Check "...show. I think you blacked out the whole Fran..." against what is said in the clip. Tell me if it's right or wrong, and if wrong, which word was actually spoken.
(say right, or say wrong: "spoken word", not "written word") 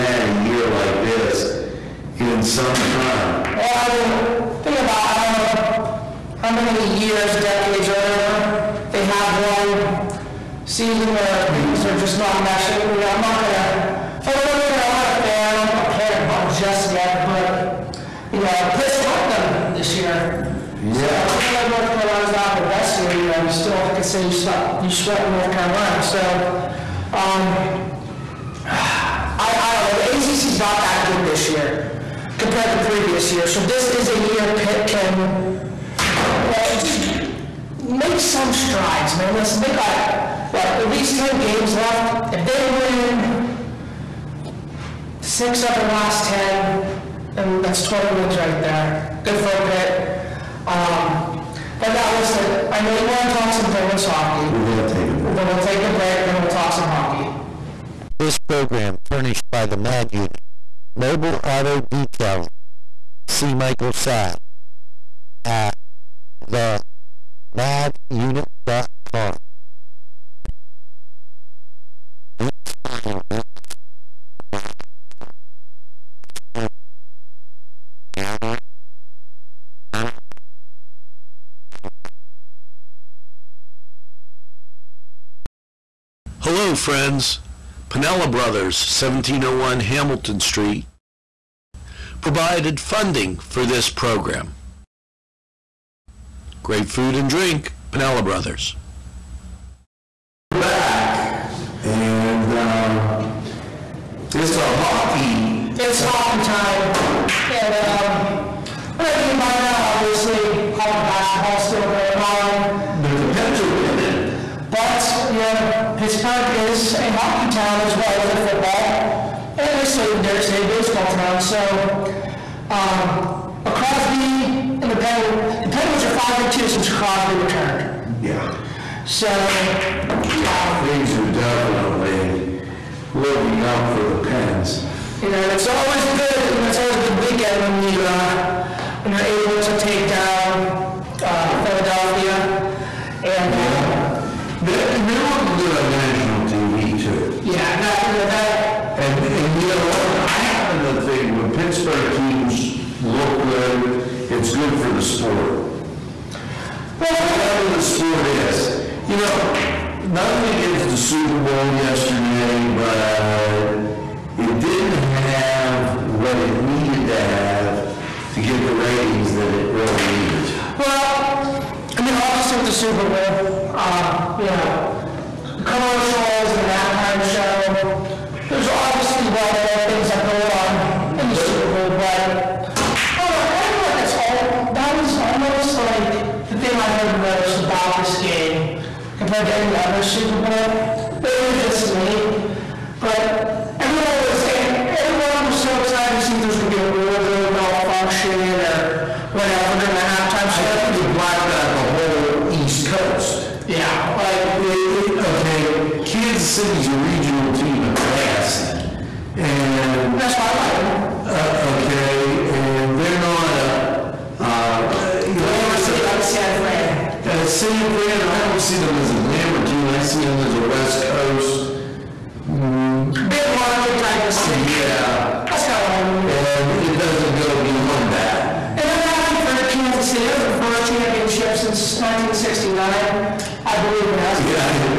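wrong: "East", not "Fran".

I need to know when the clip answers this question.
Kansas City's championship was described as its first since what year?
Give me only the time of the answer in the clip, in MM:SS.
03:51.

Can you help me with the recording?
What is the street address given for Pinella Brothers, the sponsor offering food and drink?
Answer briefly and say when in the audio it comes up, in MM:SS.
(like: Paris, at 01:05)
1701 Hamilton Street, at 01:28.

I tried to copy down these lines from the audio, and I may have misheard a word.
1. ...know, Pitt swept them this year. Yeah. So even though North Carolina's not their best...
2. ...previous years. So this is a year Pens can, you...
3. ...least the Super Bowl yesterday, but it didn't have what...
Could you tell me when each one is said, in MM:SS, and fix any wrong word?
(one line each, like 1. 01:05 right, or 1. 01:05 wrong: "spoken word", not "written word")
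1. 00:18 right
2. 00:32 wrong: "Pitt", not "Pens"
3. 02:40 wrong: "against", not "least".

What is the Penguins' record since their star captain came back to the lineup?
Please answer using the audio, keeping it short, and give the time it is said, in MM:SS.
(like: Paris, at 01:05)
5 and 2, at 02:06.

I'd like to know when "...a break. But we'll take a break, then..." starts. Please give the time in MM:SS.
00:55.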